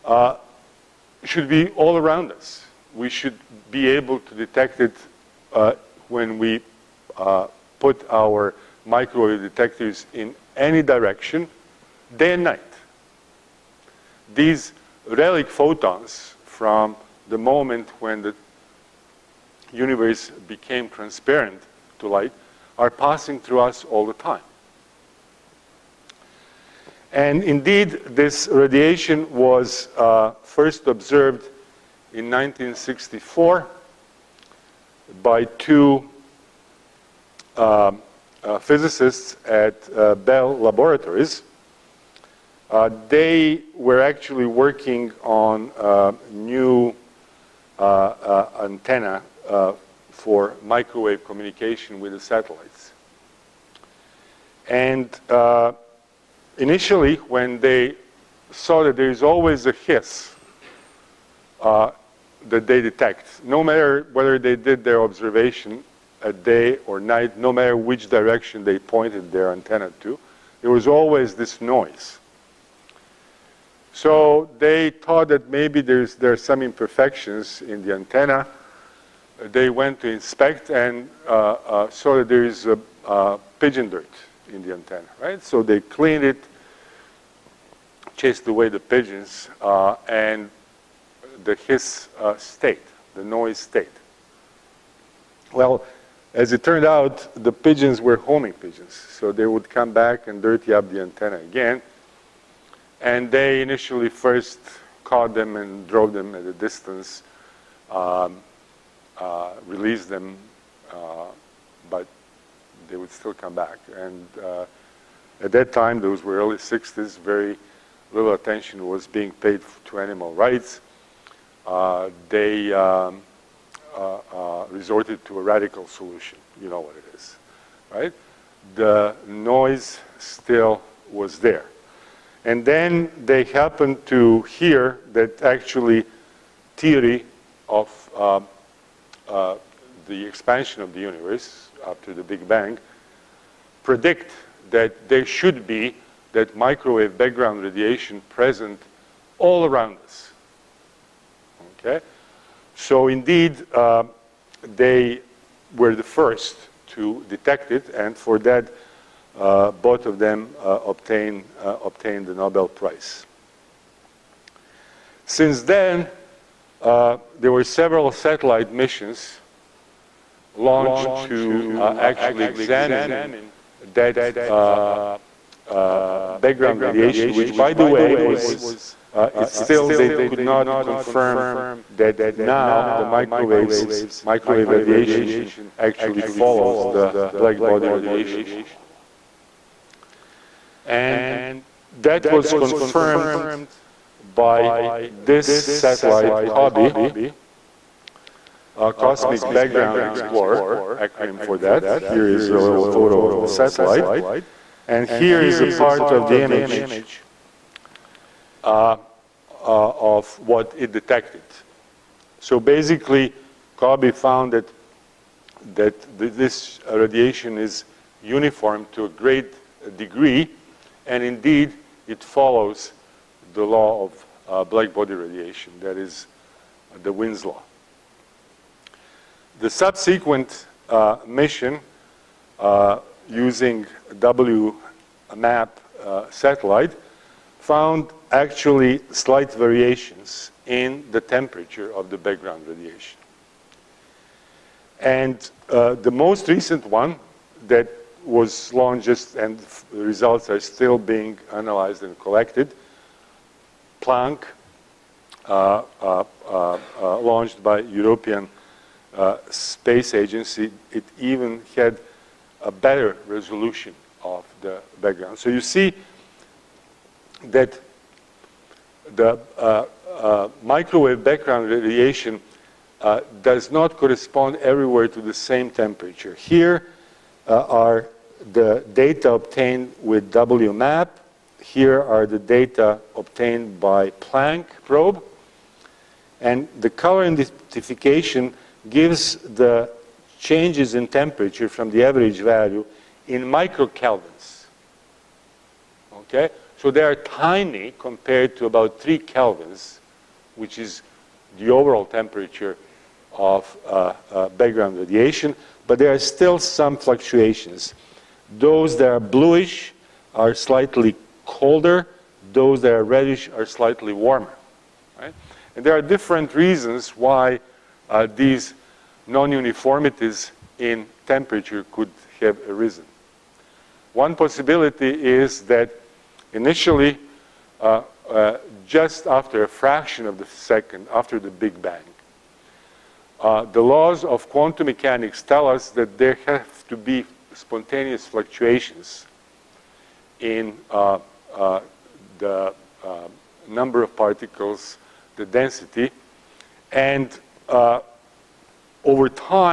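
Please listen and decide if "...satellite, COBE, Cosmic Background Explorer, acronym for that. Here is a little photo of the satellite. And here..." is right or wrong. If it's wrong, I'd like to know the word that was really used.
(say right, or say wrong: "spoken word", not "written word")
right.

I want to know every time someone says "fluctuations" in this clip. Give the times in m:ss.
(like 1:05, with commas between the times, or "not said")
5:06, 5:38.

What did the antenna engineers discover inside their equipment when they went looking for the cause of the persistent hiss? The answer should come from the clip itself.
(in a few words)
pigeon dirt.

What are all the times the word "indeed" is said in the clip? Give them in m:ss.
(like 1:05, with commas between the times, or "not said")
0:27, 2:33, 3:41.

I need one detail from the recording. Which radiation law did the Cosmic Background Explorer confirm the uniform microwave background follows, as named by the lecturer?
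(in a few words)
Wien's law.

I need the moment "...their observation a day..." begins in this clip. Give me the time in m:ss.
1:04.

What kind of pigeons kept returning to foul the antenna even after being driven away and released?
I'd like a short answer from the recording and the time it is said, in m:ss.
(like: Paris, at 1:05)
homing pigeons, at 1:38.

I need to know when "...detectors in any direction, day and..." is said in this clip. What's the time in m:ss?
0:09.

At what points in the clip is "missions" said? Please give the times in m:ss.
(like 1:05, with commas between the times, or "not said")
2:48, 3:51.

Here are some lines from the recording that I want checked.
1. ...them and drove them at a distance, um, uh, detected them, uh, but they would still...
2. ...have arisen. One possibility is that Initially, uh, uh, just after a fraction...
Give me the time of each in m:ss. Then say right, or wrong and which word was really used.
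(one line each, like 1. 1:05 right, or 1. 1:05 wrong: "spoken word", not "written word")
1. 1:45 wrong: "released", not "detected"
2. 5:22 right.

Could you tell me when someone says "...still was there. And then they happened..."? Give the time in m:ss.
2:10.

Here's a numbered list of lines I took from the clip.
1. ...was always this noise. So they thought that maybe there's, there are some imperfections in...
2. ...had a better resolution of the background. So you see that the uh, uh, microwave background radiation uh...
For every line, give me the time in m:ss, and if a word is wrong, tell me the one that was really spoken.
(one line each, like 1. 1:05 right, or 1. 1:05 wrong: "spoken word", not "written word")
1. 1:10 right
2. 4:21 right.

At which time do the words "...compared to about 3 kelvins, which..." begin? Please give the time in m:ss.
4:57.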